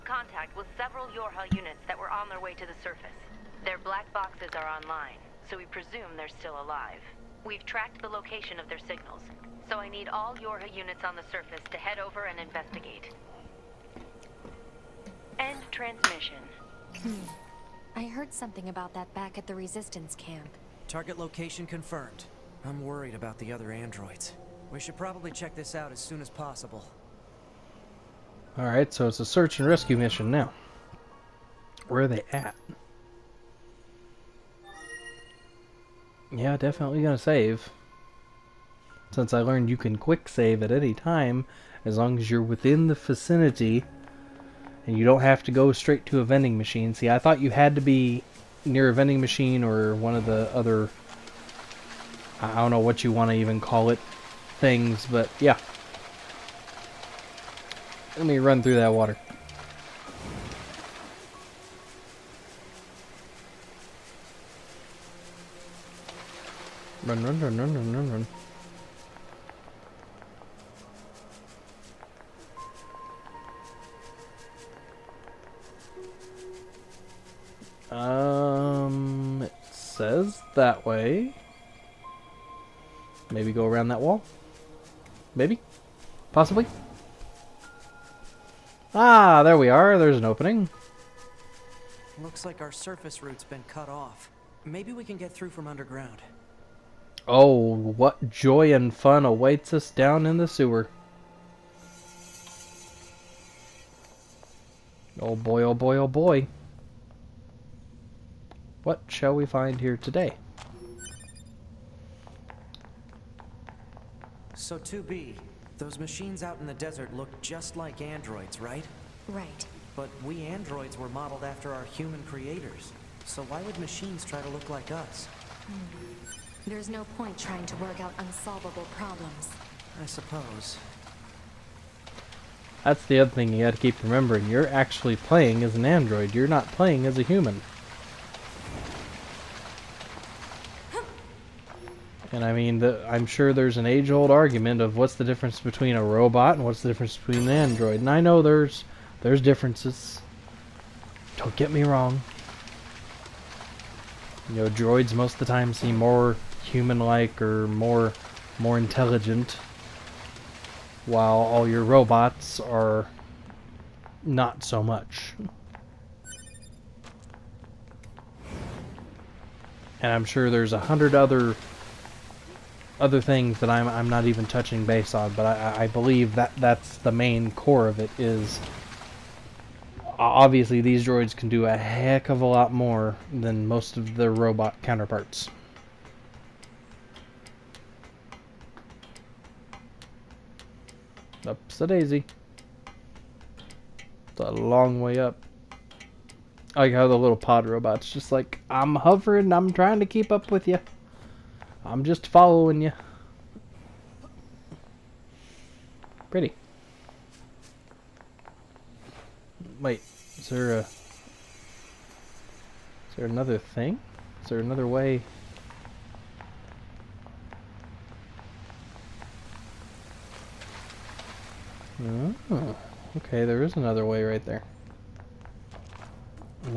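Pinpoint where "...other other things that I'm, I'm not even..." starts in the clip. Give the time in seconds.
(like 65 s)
171 s.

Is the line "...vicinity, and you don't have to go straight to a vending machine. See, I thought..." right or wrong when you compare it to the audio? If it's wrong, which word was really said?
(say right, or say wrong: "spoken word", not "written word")
right.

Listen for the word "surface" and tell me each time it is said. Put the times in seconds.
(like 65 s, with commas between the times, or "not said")
2 s, 11 s, 92 s.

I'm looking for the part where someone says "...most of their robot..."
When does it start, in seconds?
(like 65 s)
183 s.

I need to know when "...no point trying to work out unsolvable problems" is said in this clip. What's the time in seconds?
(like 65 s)
126 s.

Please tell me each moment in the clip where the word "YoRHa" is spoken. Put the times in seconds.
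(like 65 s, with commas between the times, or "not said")
1 s, 10 s.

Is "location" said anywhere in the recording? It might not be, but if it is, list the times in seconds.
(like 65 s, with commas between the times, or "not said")
8 s, 21 s.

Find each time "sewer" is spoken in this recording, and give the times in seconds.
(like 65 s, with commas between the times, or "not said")
100 s.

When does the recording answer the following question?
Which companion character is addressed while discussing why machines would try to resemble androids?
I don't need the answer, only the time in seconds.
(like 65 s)
114 s.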